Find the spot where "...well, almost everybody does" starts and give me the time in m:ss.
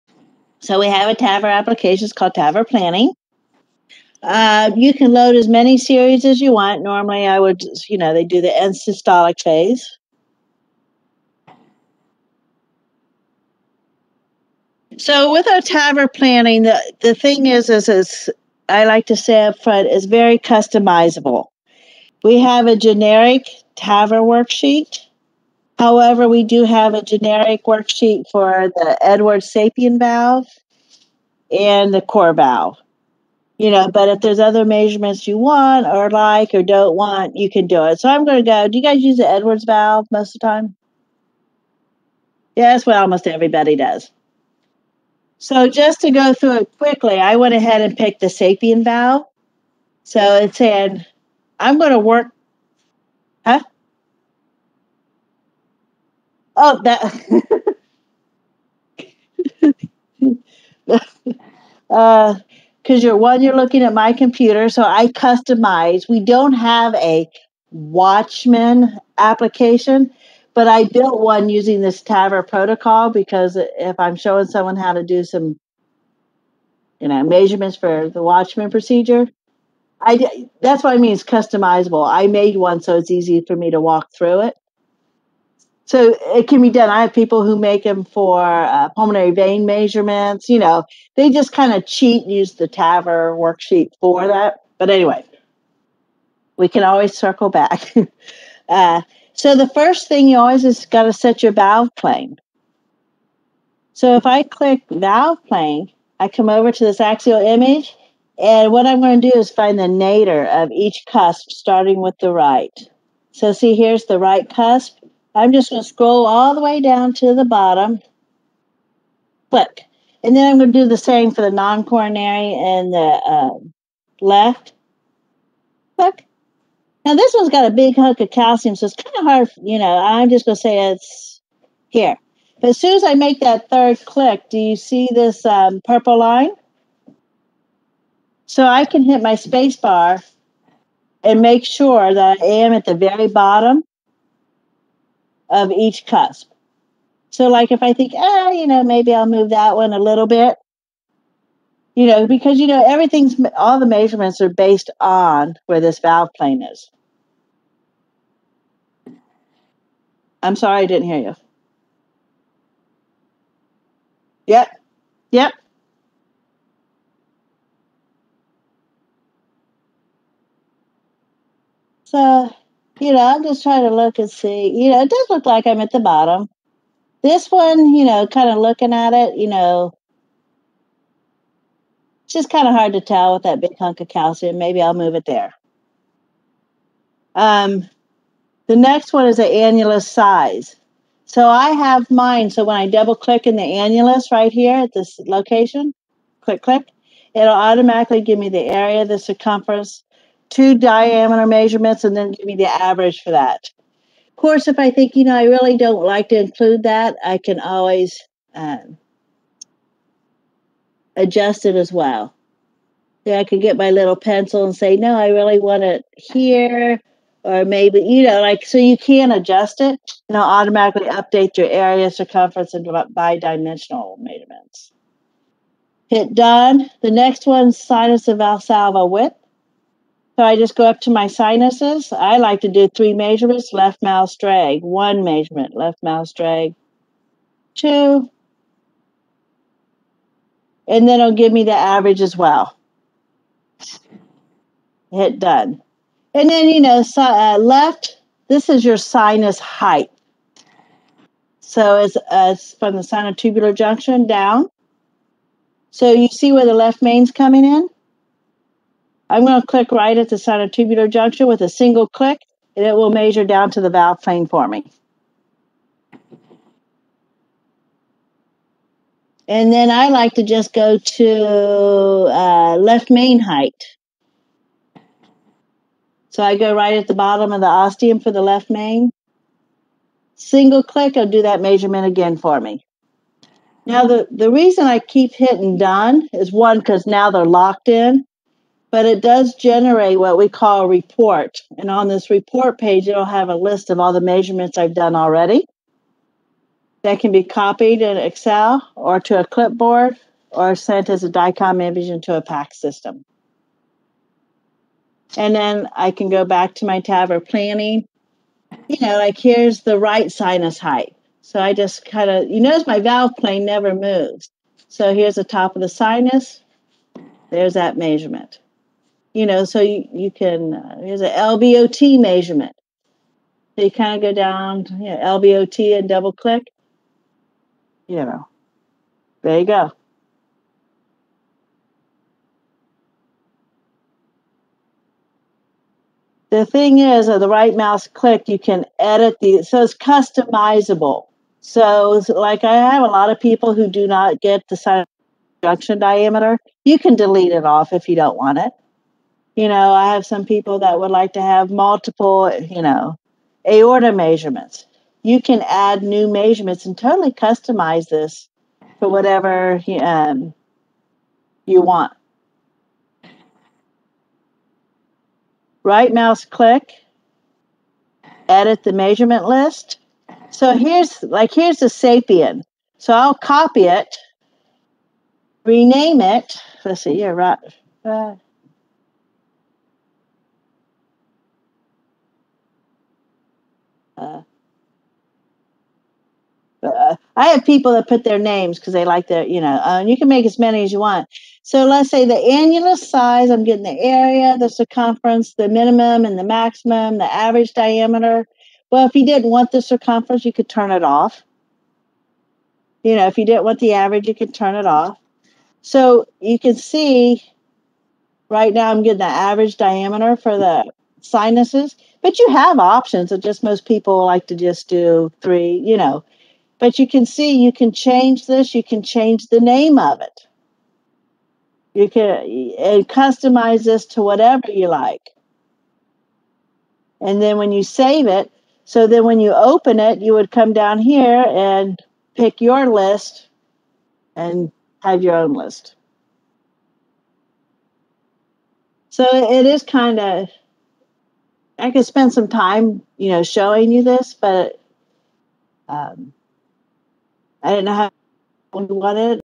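0:42.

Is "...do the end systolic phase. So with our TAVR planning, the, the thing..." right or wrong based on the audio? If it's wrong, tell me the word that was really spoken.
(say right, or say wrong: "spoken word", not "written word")
right.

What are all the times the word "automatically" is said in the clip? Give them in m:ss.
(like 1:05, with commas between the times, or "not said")
3:17, 3:40.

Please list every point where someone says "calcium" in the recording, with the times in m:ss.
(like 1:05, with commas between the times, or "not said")
2:08, 3:04.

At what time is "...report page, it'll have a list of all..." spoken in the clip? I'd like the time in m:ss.
4:52.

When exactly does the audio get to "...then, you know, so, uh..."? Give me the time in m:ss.
4:06.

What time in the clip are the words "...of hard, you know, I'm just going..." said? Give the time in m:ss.
2:09.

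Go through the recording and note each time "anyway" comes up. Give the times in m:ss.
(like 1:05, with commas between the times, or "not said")
1:34.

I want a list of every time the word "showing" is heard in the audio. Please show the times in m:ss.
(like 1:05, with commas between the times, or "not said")
1:14, 7:23.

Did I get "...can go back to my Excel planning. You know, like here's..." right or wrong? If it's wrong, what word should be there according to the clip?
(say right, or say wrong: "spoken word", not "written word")
wrong: "TAVR", not "Excel".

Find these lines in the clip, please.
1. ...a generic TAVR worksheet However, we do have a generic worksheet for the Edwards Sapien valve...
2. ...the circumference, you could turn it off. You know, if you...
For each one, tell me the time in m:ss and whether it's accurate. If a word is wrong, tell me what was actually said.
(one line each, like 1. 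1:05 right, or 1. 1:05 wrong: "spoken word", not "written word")
1. 0:22 right
2. 6:39 right.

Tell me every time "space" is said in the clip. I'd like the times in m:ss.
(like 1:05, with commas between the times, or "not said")
2:19.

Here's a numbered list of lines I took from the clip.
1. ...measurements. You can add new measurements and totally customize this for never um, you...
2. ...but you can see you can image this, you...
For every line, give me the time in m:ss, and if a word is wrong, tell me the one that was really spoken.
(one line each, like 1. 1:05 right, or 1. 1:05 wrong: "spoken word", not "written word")
1. 5:54 wrong: "whatever", not "never"
2. 6:56 wrong: "change", not "image".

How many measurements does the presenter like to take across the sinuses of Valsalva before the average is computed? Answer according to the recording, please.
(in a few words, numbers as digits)
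3.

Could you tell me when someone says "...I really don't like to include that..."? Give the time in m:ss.
3:25.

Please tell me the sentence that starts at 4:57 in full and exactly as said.
That can be copied in Excel or to a clipboard or sent as a DICOM image into a PAC system.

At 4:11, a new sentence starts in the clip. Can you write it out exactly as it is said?
So it's, uh, it's from the sinotubular junction down.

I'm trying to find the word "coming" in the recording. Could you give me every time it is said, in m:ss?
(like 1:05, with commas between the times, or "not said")
4:17.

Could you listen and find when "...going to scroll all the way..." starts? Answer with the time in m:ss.
1:55.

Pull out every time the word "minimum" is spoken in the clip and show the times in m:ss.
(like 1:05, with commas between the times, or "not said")
6:35.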